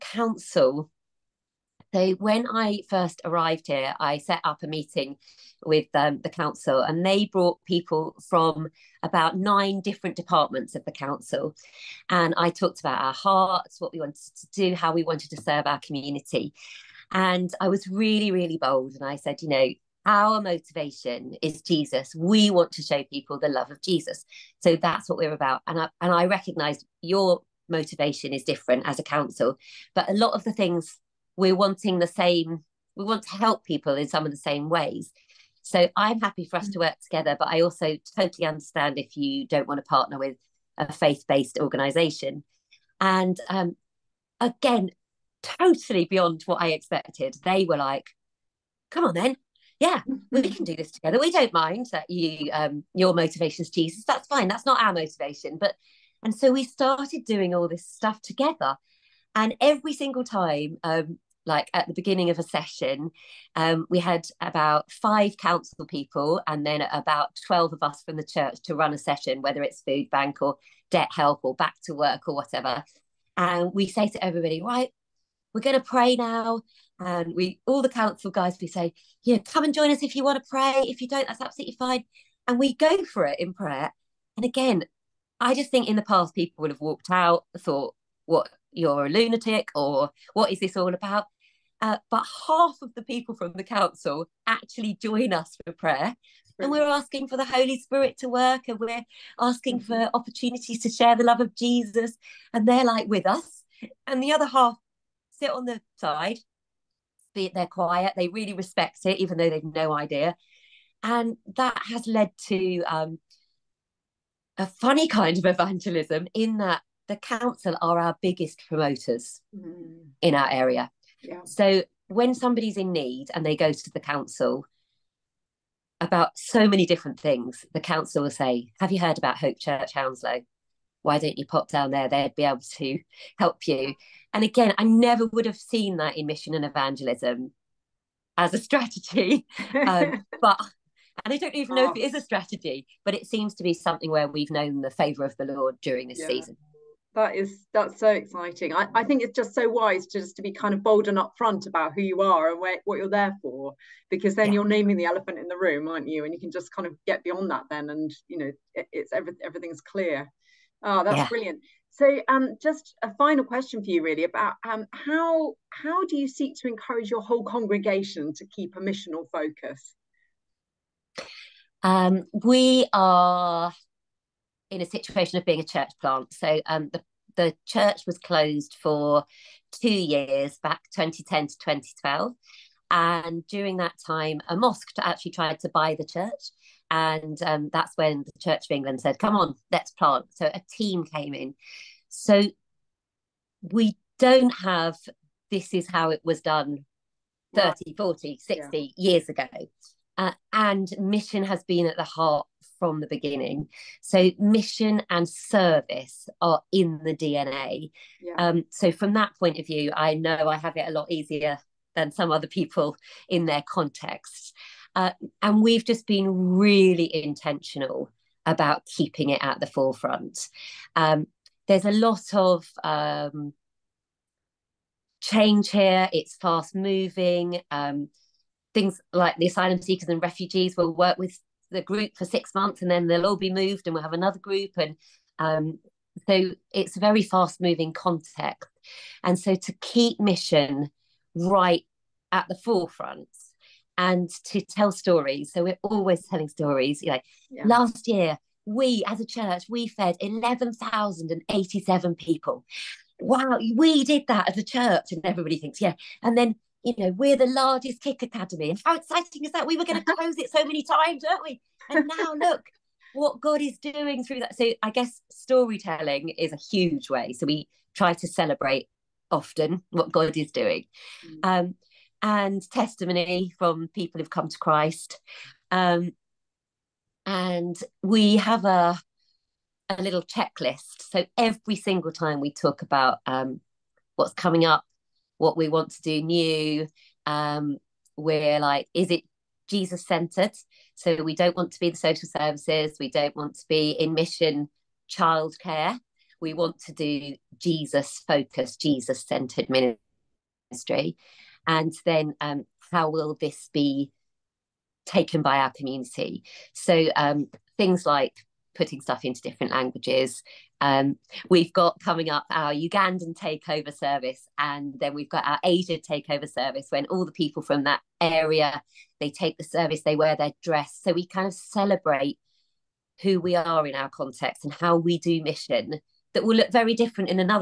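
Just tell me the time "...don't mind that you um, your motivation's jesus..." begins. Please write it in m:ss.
0:51.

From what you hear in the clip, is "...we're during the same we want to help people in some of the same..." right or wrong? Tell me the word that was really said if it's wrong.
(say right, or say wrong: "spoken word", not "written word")
wrong: "wanting", not "during".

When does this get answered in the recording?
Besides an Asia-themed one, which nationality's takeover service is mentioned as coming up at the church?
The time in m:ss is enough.
5:12.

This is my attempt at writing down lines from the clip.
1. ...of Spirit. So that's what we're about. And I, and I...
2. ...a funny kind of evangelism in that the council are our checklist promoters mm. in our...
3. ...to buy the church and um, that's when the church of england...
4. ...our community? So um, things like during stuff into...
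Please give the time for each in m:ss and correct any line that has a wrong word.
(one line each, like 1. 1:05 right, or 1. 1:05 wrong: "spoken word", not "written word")
1. 0:23 wrong: "Jesus", not "Spirit"
2. 1:54 wrong: "biggest", not "checklist"
3. 3:05 right
4. 5:05 wrong: "putting", not "during".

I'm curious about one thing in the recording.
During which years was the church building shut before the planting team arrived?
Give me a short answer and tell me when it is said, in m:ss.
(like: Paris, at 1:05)
2010 to 2012, at 3:00.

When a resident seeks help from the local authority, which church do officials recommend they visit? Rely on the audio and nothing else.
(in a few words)
Hope Church Hounslow.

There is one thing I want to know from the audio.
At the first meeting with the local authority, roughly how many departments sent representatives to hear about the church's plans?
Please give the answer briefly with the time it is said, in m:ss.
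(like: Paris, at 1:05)
9, at 0:09.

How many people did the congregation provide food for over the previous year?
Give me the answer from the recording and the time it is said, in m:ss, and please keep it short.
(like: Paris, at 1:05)
11,087, at 4:10.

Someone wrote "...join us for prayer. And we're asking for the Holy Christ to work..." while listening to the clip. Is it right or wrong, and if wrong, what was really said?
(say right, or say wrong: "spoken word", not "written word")
wrong: "Spirit", not "Christ".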